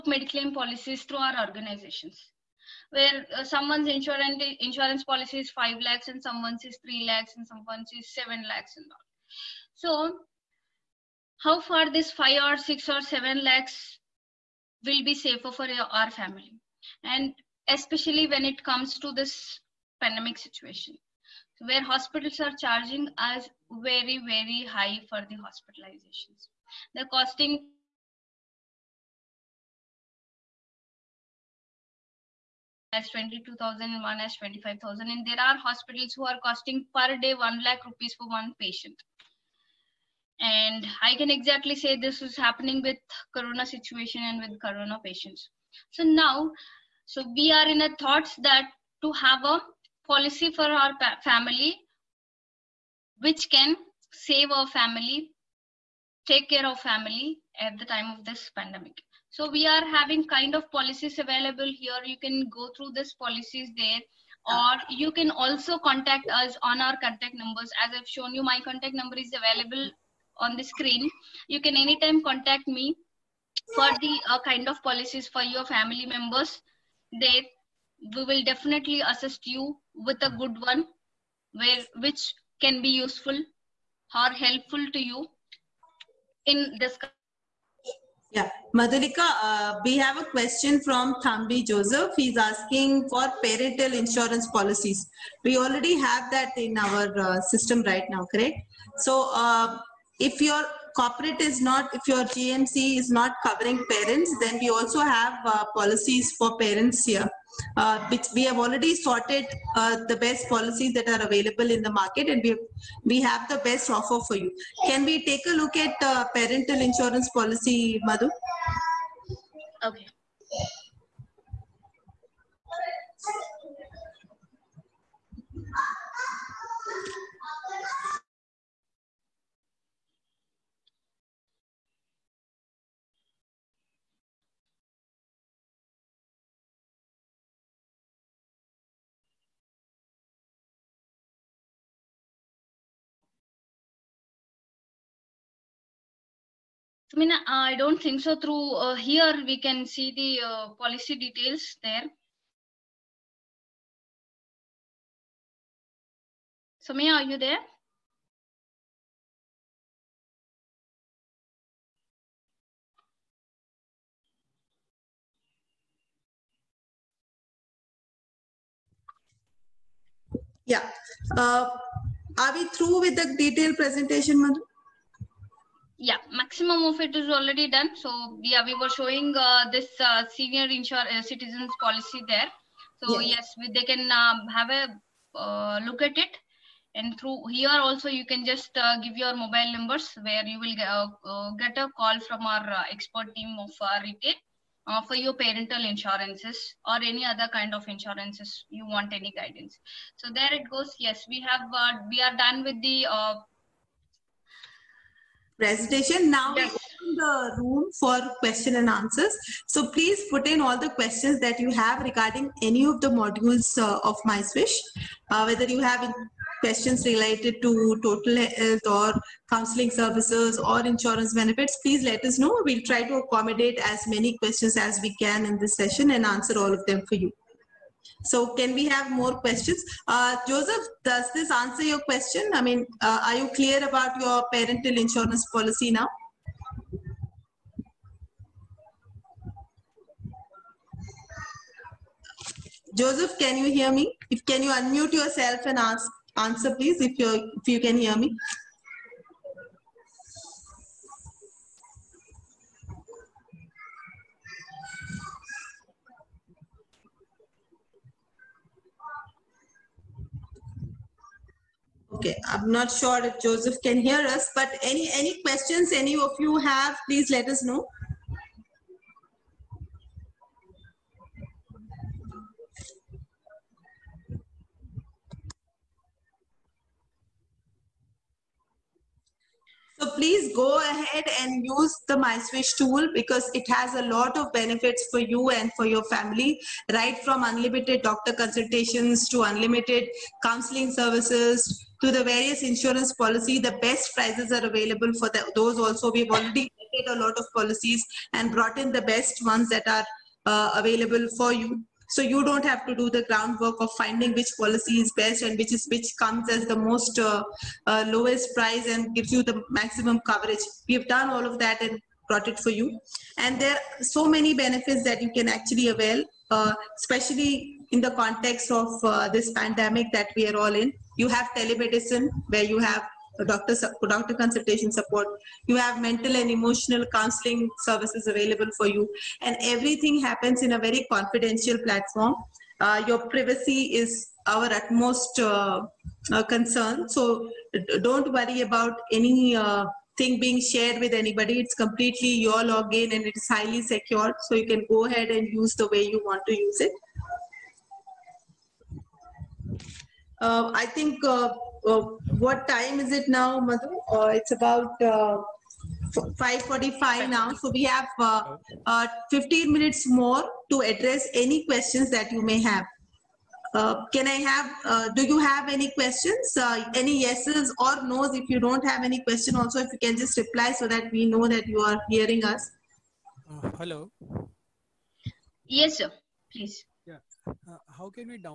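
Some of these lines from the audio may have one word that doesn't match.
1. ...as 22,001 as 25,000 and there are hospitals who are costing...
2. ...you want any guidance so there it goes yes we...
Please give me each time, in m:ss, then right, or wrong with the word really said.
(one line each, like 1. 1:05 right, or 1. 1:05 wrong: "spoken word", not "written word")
1. 0:32 right
2. 3:18 right.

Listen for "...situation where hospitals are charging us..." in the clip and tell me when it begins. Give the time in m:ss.
0:20.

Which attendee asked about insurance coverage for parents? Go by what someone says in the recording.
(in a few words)
Thambi Joseph.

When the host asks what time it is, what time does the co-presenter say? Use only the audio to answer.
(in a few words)
5:45.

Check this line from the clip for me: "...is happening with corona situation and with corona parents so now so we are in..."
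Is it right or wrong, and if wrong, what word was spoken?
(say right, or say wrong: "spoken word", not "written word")
wrong: "patients", not "parents".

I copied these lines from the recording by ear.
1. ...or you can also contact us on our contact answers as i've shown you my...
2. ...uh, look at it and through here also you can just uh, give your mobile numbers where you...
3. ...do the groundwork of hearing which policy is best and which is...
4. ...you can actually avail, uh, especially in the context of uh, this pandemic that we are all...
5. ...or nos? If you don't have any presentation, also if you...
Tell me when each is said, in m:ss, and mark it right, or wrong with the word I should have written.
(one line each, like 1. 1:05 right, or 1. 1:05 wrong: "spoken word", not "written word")
1. 1:04 wrong: "numbers", not "answers"
2. 3:05 right
3. 5:02 wrong: "finding", not "hearing"
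4. 5:15 right
5. 6:07 wrong: "question", not "presentation".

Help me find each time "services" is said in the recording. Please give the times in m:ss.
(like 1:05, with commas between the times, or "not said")
3:39, 4:50, 5:27.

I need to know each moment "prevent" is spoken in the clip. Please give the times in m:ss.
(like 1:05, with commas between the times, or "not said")
not said.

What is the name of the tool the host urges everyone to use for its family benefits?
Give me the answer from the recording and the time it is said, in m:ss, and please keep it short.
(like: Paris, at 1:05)
MySwish, at 4:42.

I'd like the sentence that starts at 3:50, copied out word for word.
Uh, Joseph, does this answer your question?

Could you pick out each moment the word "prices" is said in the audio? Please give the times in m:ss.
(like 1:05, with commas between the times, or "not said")
4:54, 5:08.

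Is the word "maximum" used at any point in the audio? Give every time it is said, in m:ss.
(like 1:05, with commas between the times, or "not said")
2:56, 5:09.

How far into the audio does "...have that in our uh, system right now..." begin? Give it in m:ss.
1:35.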